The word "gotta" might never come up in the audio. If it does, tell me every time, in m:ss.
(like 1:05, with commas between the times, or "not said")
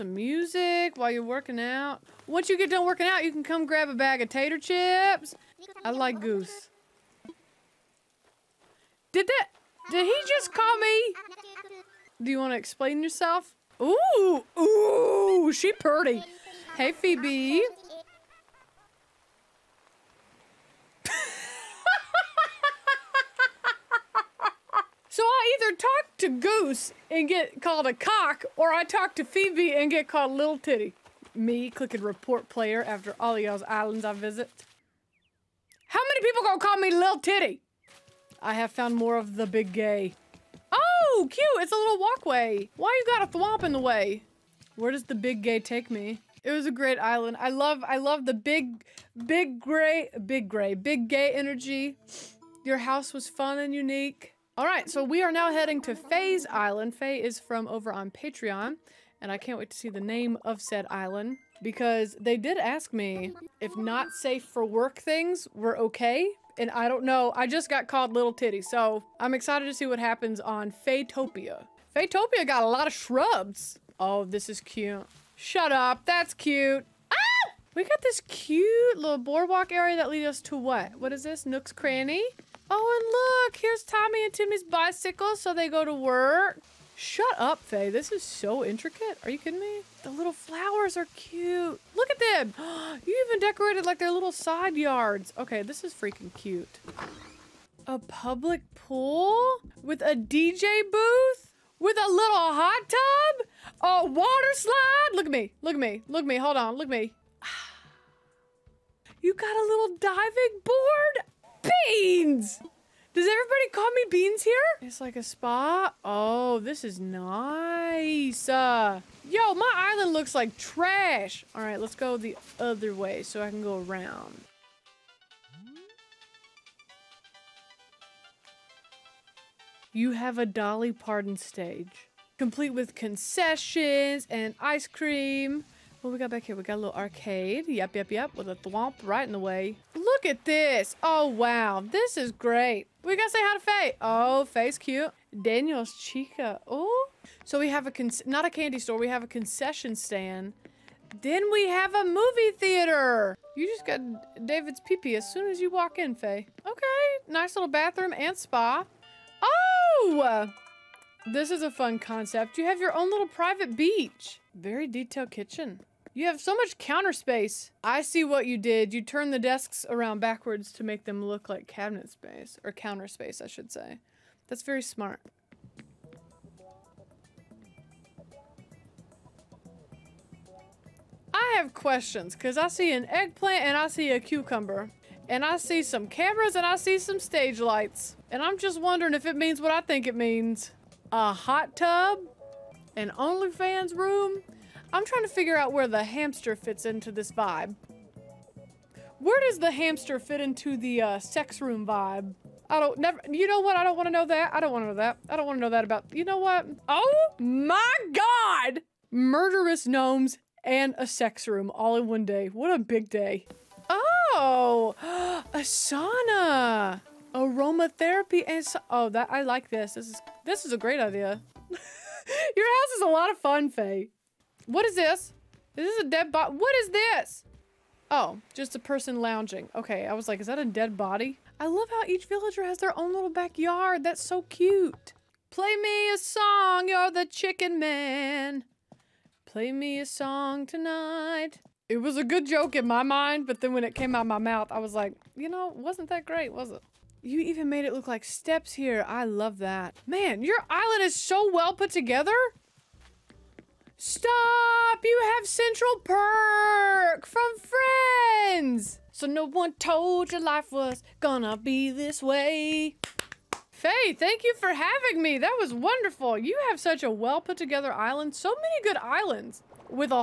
2:23.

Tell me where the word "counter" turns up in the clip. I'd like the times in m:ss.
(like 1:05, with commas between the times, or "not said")
2:46, 2:52.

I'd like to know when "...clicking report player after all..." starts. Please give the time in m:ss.
0:31.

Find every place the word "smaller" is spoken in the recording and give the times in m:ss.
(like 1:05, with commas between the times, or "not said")
not said.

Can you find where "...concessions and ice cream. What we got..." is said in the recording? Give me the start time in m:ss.
2:12.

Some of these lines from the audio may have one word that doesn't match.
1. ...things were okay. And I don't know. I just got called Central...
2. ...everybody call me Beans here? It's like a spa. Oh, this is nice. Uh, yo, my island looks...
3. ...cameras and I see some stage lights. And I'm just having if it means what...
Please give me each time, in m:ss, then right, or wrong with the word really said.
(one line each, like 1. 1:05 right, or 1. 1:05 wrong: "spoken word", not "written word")
1. 1:04 wrong: "Little", not "Central"
2. 1:53 right
3. 3:06 wrong: "wondering", not "having".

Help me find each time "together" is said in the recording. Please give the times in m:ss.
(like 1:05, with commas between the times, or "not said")
4:11, 4:27.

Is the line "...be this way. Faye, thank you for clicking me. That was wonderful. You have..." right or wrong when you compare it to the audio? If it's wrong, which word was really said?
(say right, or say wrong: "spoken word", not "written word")
wrong: "having", not "clicking".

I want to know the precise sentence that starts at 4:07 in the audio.
You even made it look like steps here.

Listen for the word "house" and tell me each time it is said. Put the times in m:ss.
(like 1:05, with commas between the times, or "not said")
0:52, 3:42.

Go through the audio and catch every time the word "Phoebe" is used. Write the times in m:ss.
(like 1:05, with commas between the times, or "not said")
0:16, 0:29.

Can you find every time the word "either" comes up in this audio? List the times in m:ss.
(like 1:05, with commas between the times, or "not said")
0:25.